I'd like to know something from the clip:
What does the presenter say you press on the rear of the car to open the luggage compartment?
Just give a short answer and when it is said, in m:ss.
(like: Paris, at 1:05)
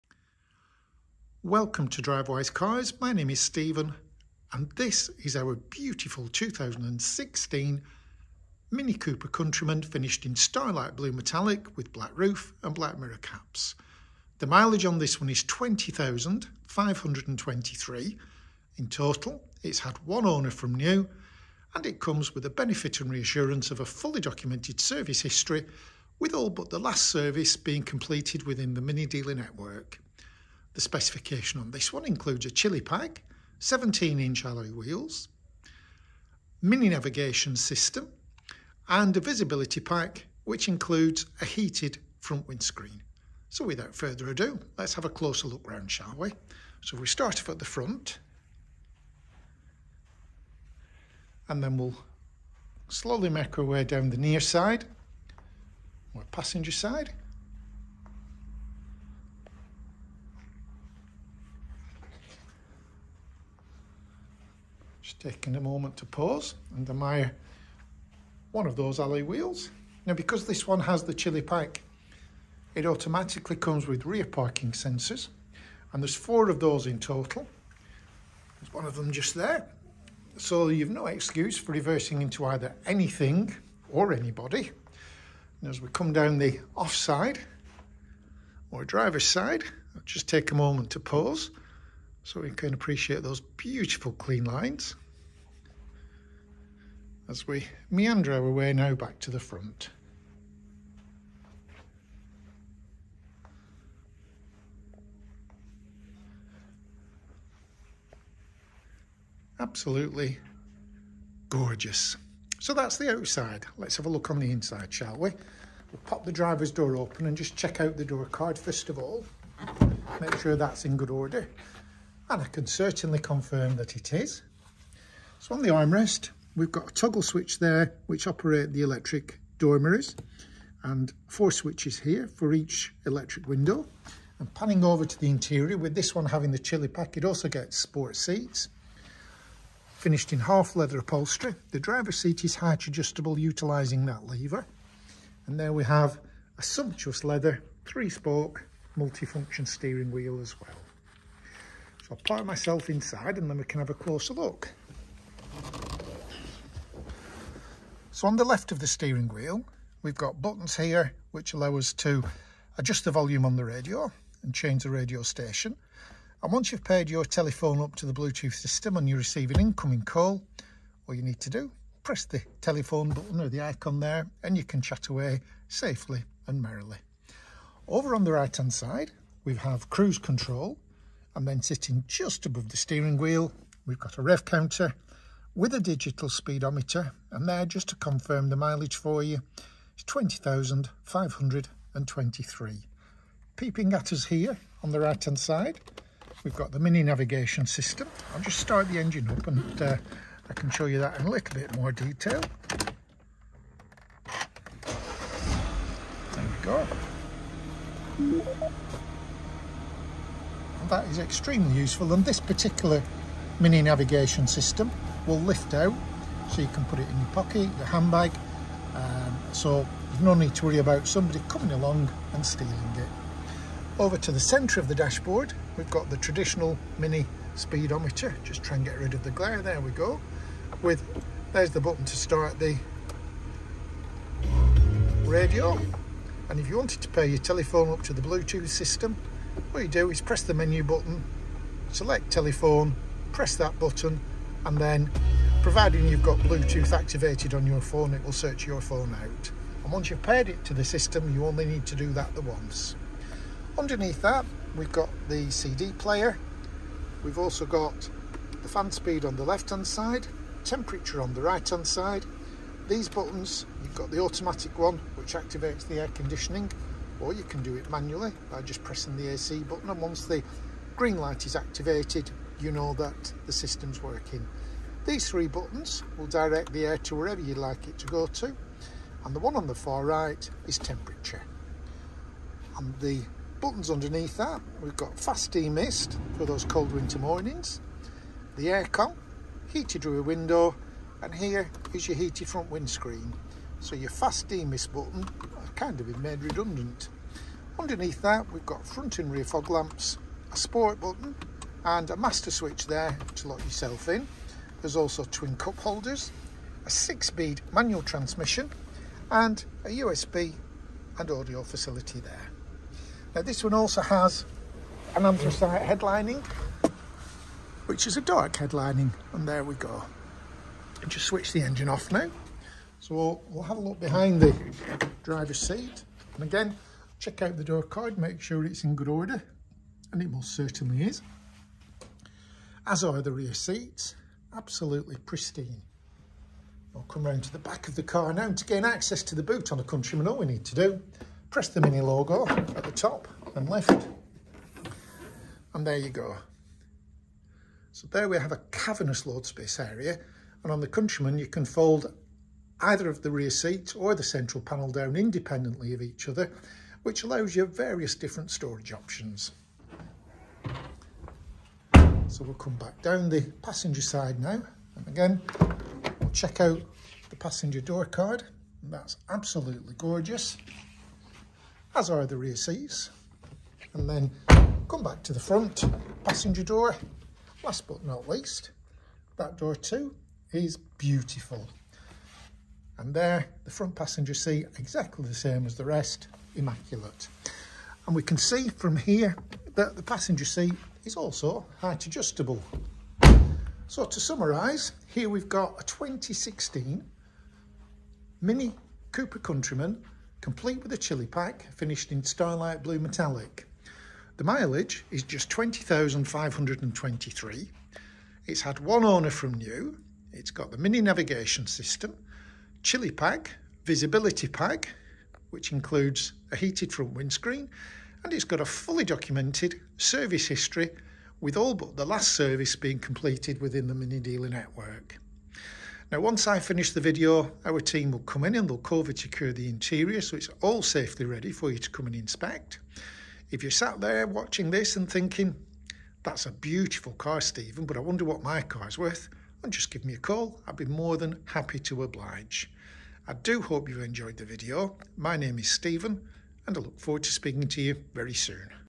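The Mini logo, at 5:41.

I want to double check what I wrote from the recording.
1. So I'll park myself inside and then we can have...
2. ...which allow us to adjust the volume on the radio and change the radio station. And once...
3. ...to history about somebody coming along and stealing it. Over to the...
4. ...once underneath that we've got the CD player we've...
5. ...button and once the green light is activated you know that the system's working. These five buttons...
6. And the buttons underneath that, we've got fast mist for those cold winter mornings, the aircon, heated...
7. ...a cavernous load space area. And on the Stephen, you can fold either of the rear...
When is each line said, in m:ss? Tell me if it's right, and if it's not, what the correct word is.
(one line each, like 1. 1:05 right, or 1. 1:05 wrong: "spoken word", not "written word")
1. 2:32 right
2. 2:41 right
3. 3:40 wrong: "worry", not "history"
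4. 4:12 right
5. 4:29 wrong: "three", not "five"
6. 4:42 right
7. 5:48 wrong: "Countryman", not "Stephen".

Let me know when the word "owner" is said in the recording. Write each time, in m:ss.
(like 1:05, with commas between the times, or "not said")
0:20, 6:49.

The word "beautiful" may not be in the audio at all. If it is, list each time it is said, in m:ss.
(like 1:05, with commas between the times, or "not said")
0:05, 1:33, 6:20, 7:16.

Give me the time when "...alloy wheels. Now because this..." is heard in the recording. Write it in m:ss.
1:08.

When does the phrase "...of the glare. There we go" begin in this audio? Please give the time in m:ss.
3:49.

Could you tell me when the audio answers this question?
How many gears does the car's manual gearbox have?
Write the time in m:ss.
5:06.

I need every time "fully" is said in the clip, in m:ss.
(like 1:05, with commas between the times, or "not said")
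0:23, 6:58.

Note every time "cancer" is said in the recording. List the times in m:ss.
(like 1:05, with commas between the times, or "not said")
not said.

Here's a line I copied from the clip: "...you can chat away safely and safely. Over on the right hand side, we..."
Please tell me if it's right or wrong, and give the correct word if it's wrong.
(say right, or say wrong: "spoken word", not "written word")
wrong: "merrily", not "safely".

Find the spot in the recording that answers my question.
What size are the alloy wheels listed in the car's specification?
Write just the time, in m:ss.
0:33.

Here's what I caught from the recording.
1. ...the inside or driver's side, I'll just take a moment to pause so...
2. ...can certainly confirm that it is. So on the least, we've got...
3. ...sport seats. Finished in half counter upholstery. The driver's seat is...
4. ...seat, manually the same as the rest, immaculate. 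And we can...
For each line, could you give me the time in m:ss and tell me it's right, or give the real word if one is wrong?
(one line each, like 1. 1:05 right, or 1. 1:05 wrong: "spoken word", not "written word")
1. 1:26 wrong: "offside", not "inside"
2. 2:02 wrong: "armrest", not "least"
3. 2:17 wrong: "leather", not "counter"
4. 6:24 wrong: "exactly", not "manually".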